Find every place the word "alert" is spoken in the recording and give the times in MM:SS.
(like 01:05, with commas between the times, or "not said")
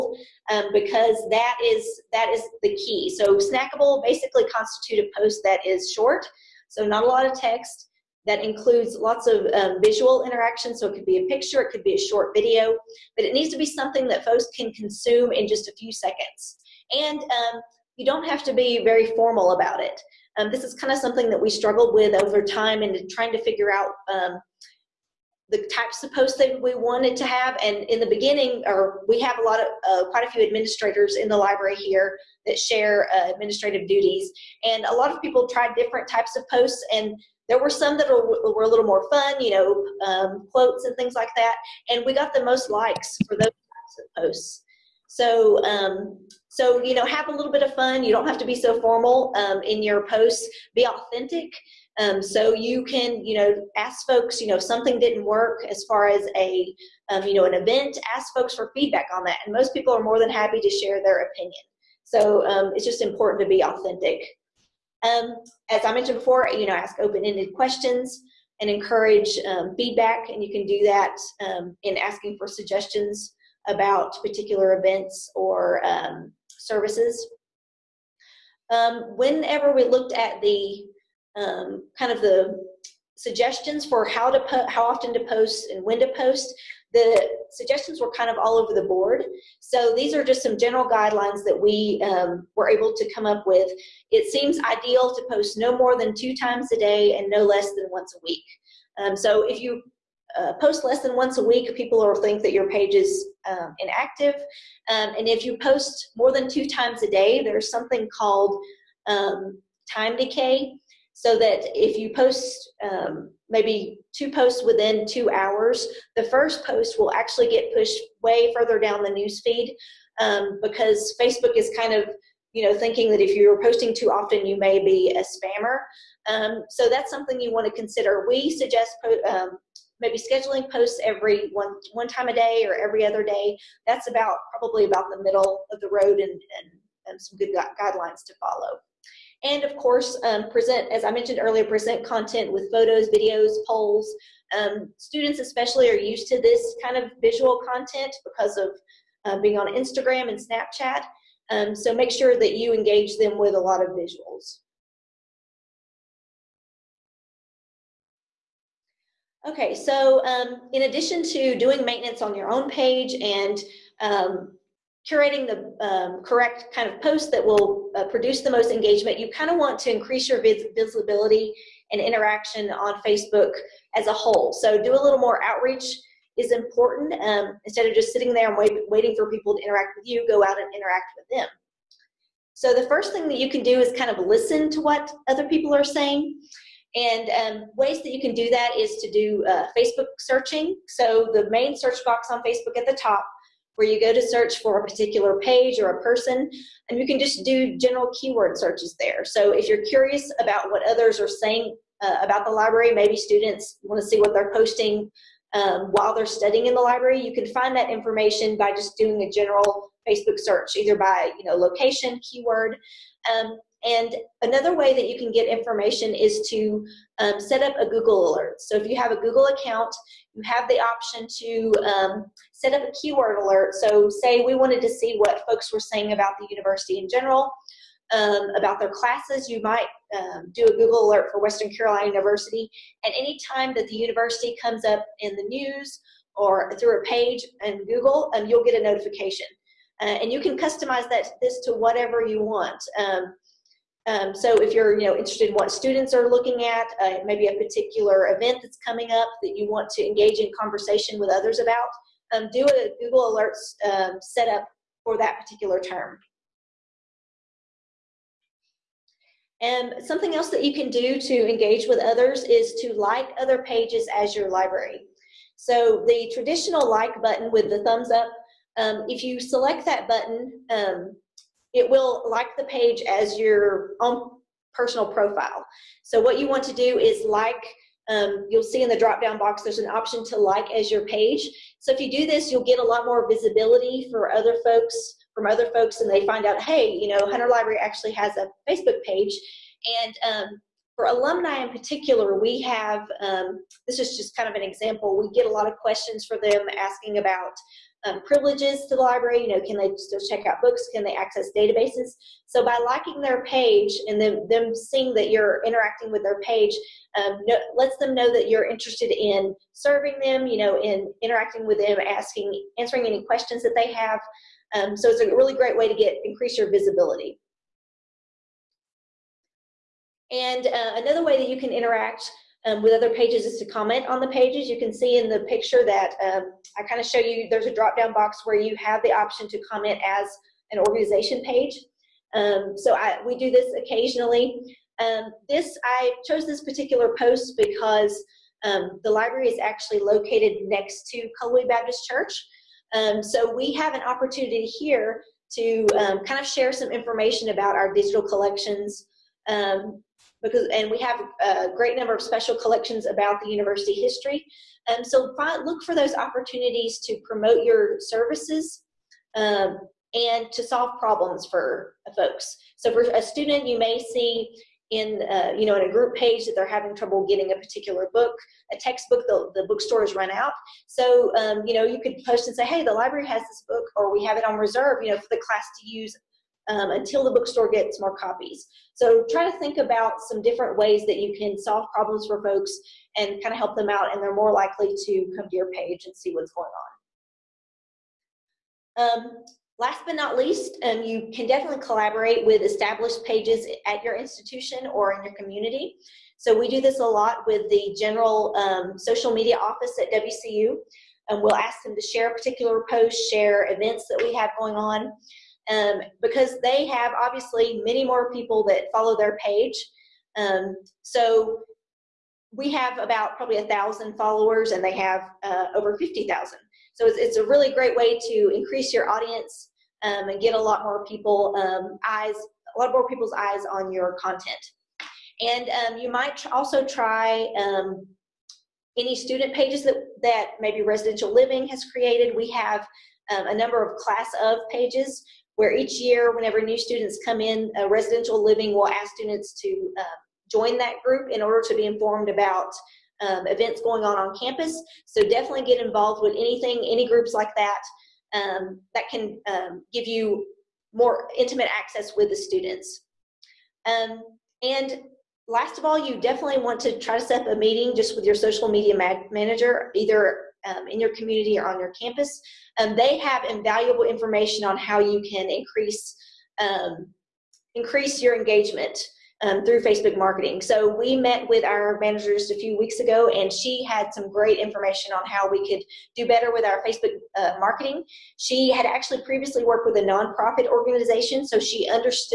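03:38, 03:43, 03:51, 04:13.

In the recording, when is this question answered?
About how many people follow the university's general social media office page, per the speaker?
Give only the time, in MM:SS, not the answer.
06:55.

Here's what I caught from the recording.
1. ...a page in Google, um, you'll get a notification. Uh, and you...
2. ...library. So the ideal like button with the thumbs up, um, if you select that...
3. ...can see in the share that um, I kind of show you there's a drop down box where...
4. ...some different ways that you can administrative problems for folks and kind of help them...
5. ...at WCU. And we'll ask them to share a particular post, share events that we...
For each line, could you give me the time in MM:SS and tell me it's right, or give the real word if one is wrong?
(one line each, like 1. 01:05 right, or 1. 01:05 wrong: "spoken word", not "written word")
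1. 03:56 right
2. 04:24 wrong: "traditional", not "ideal"
3. 05:24 wrong: "picture", not "share"
4. 06:20 wrong: "solve", not "administrative"
5. 06:40 right.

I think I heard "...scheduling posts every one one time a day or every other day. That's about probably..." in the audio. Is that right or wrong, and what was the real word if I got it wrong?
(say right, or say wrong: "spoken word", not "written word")
right.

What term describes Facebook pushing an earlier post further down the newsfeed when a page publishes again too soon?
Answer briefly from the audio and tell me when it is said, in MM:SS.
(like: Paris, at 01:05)
time decay, at 01:49.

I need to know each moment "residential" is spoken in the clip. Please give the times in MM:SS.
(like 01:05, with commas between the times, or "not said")
07:10, 07:17.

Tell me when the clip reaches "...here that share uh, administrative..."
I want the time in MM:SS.
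00:31.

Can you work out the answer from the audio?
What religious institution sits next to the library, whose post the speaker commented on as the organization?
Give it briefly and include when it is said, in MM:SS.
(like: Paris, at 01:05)
Cullowhee Baptist Church, at 05:41.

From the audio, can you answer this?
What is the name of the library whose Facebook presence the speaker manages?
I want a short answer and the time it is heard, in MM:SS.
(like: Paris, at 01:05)
Hunter Library, at 04:47.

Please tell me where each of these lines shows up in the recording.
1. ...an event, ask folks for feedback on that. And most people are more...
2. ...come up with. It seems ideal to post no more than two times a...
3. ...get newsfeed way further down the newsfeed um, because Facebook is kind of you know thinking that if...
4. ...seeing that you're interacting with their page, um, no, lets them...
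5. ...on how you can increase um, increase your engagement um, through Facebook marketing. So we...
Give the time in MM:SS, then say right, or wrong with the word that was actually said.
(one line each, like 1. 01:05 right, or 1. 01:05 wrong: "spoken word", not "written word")
1. 00:57 right
2. 01:33 right
3. 01:57 wrong: "pushed", not "newsfeed"
4. 05:04 right
5. 07:44 right.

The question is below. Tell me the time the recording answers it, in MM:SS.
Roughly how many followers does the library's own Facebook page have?
06:53.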